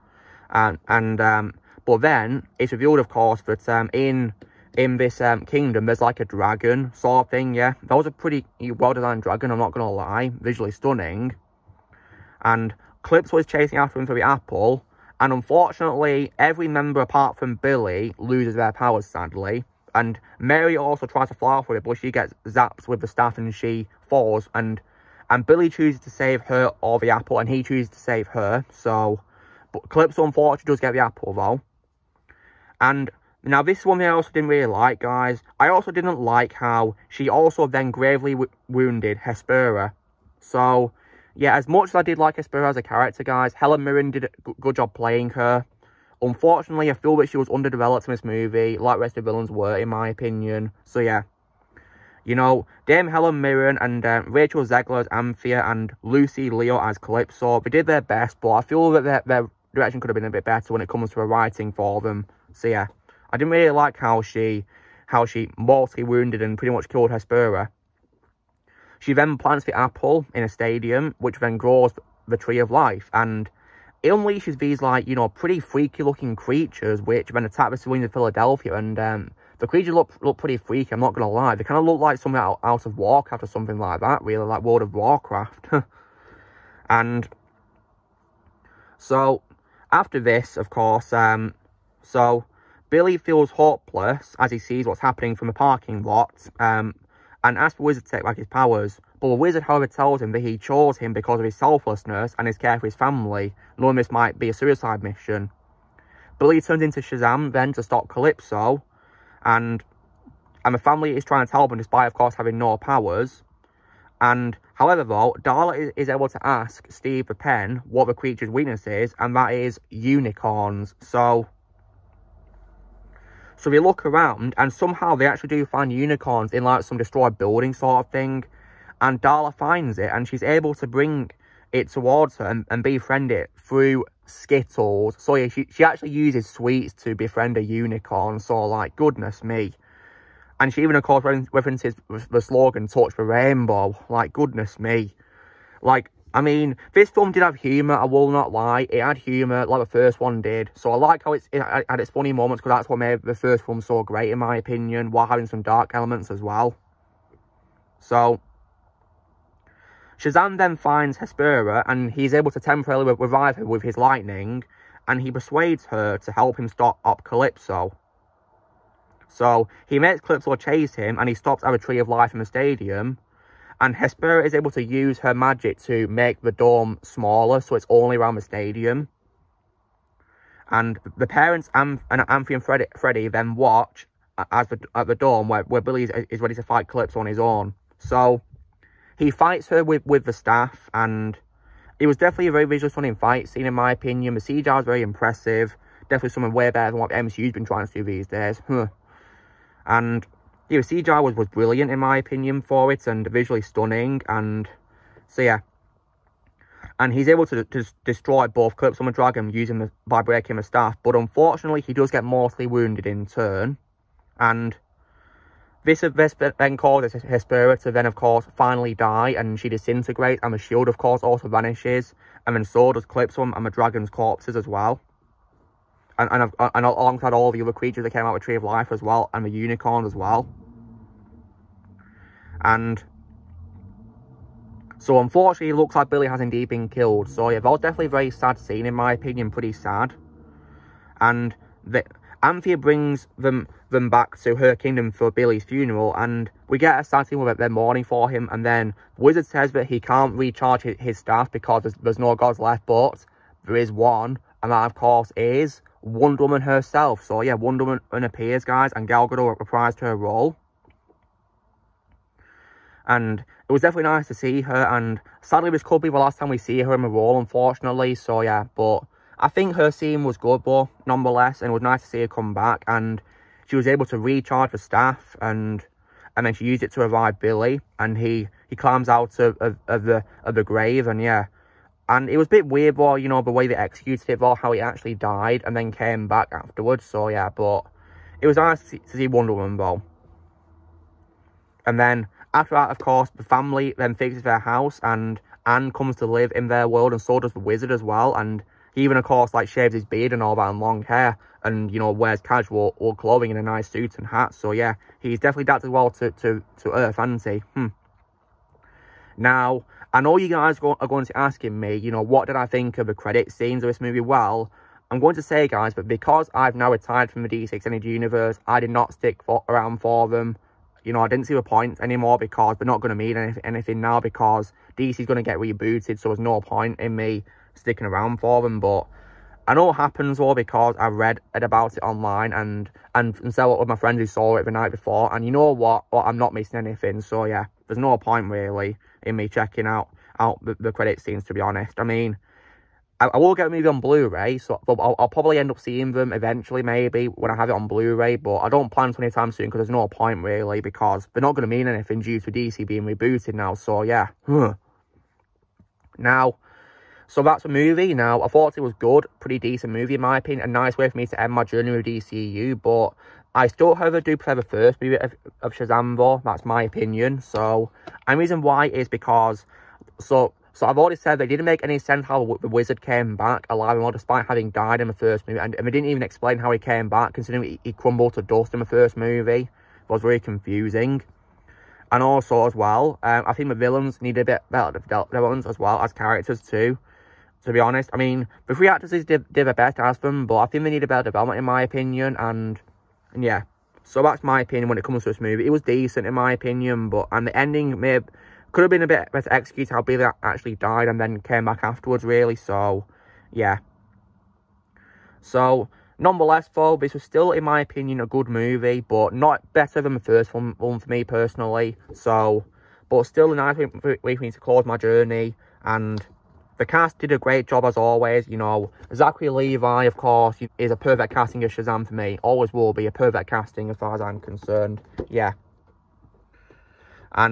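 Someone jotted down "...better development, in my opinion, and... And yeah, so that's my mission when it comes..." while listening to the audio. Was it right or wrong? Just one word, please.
wrong.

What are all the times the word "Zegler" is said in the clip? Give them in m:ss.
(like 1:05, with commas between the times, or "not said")
0:54.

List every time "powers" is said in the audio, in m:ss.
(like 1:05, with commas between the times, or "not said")
0:18, 1:38, 1:52.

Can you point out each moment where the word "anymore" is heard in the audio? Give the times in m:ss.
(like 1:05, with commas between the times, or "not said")
5:21.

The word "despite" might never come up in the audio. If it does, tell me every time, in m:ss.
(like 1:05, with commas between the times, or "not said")
1:51, 6:14.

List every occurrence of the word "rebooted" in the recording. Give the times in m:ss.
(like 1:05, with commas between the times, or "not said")
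5:25, 5:53.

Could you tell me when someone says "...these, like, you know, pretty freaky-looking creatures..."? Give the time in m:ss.
1:14.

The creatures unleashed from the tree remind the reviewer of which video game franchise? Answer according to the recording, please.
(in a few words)
World of Warcraft.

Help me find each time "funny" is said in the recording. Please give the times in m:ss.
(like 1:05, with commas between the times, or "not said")
2:32.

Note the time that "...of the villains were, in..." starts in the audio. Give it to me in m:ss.
0:49.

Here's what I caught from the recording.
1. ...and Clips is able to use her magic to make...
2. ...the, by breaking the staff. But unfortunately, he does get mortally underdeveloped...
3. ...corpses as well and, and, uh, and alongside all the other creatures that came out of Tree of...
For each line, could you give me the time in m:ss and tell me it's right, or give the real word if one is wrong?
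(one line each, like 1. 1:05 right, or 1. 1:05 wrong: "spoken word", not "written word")
1. 2:53 wrong: "Hespera", not "Clips"
2. 3:29 wrong: "wounded", not "underdeveloped"
3. 3:44 right.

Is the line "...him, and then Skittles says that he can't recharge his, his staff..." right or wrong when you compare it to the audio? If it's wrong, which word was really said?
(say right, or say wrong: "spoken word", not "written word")
wrong: "Wizard", not "Skittles".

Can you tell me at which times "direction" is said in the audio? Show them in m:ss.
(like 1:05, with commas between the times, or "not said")
0:59.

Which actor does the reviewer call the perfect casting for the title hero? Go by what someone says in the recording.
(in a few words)
Zachary Levi.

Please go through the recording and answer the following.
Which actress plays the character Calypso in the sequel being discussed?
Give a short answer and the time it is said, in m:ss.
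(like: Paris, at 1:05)
Lucy Liu, at 0:56.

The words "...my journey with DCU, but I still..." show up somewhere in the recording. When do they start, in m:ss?
6:01.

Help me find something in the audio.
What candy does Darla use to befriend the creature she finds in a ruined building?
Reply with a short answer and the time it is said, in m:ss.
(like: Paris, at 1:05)
Skittles, at 2:14.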